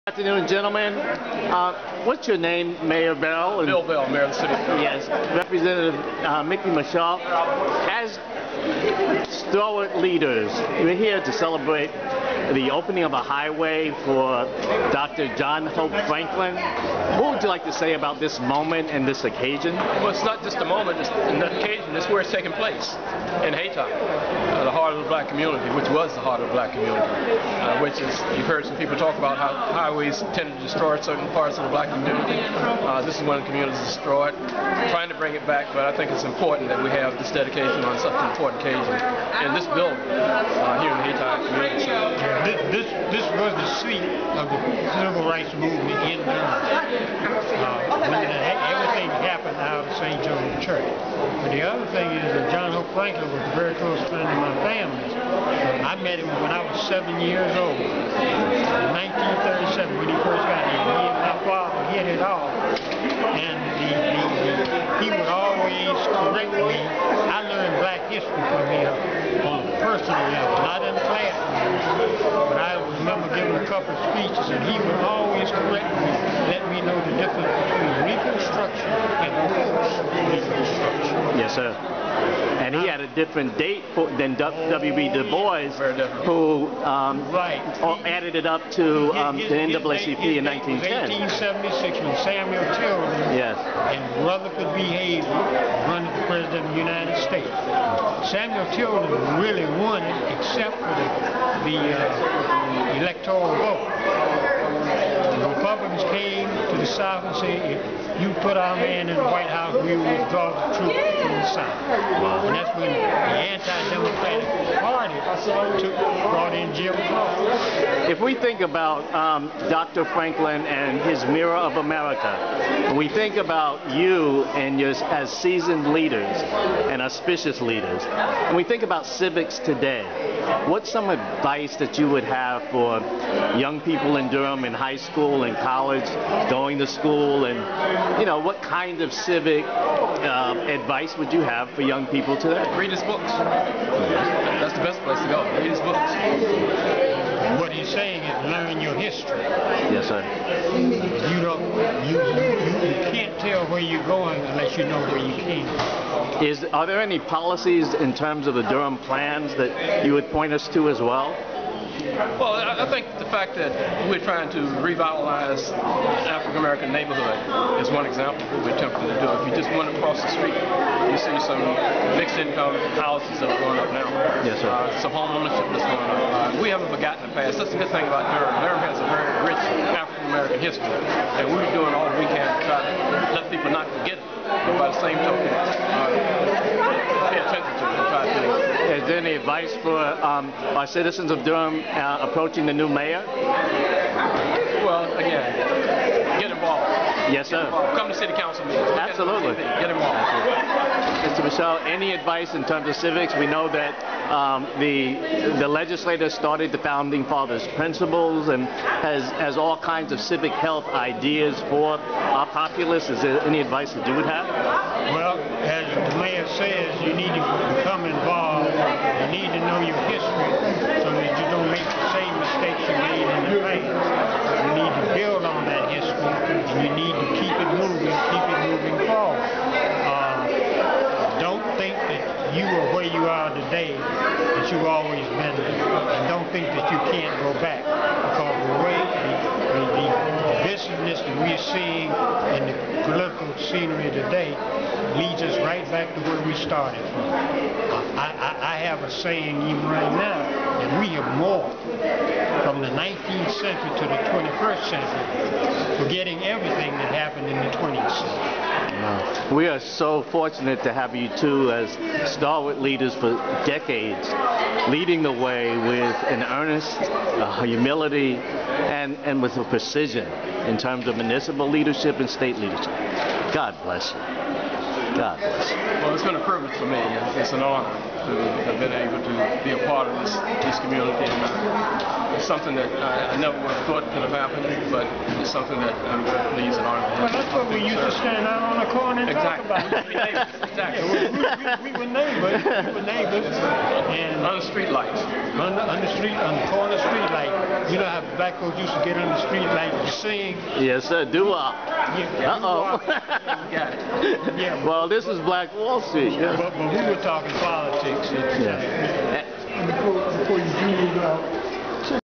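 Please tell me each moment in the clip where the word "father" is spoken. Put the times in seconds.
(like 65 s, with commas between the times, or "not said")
61 s, 207 s.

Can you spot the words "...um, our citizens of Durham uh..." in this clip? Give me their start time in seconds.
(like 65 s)
189 s.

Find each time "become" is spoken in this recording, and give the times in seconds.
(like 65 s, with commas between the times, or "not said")
217 s.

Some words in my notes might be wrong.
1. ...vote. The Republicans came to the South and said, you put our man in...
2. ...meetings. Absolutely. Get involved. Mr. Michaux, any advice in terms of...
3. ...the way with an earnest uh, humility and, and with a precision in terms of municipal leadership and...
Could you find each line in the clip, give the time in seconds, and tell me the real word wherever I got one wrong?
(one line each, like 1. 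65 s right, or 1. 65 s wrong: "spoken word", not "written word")
1. 103 s right
2. 198 s right
3. 265 s right.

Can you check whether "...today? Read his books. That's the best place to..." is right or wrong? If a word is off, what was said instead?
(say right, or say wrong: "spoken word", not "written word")
right.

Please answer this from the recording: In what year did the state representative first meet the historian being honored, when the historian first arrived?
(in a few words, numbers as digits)
1937.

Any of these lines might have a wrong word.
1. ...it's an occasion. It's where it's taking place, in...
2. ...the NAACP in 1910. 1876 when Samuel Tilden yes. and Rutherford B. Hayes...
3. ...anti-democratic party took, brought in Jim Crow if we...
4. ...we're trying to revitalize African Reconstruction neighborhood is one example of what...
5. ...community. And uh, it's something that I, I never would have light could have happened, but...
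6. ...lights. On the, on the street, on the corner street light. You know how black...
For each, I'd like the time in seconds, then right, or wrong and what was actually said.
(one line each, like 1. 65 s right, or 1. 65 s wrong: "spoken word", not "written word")
1. 20 s right
2. 89 s right
3. 113 s right
4. 164 s wrong: "American", not "Reconstruction"
5. 280 s wrong: "thought", not "light"
6. 294 s right.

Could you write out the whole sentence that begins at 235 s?
And don't think that you can't go back.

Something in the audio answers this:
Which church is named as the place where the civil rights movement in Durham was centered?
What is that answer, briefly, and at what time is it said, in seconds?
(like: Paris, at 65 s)
St. John's Church, at 49 s.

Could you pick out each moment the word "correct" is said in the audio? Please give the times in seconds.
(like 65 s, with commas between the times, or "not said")
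66 s, 75 s.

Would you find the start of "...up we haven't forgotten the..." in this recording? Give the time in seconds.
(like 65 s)
176 s.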